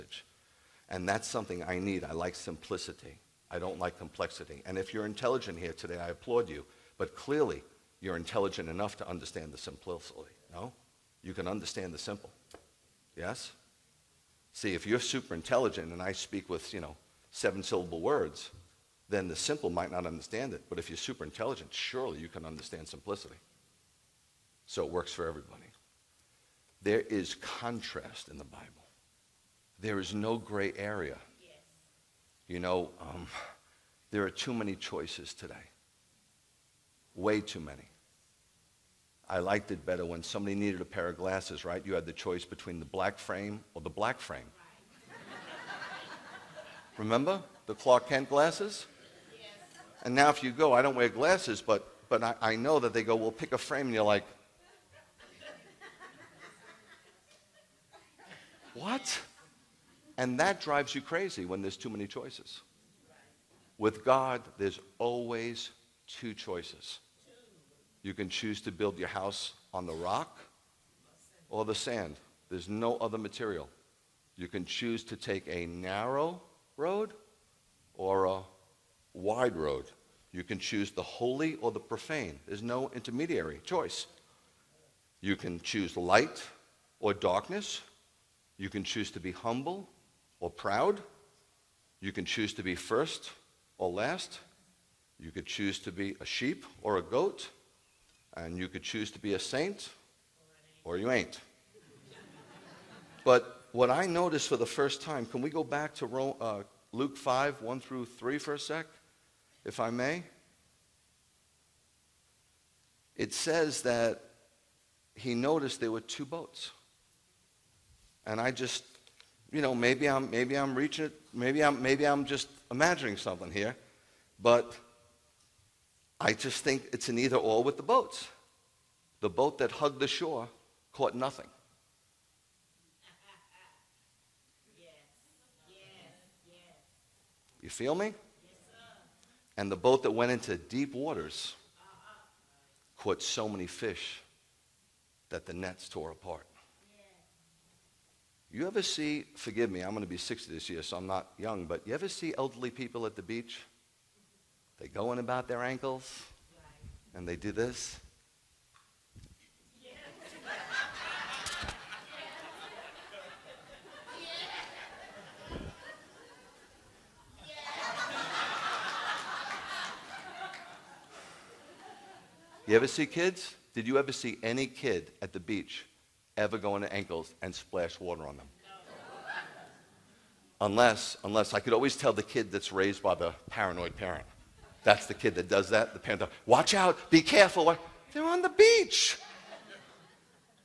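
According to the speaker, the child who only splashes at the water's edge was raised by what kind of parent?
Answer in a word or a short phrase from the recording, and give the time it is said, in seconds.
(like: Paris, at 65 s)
paranoid, at 183 s.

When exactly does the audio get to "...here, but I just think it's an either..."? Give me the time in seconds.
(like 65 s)
123 s.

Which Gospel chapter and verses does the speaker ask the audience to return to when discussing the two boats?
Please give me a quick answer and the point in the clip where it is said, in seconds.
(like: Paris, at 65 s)
Luke 5:1-3, at 106 s.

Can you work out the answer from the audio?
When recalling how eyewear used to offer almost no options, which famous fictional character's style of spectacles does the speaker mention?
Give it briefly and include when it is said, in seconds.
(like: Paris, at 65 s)
Clark Kent, at 47 s.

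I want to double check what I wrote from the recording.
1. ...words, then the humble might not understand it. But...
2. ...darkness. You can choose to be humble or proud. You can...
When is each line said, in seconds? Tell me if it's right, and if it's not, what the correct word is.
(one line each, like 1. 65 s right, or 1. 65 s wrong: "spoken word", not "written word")
1. 18 s wrong: "simple", not "humble"
2. 87 s right.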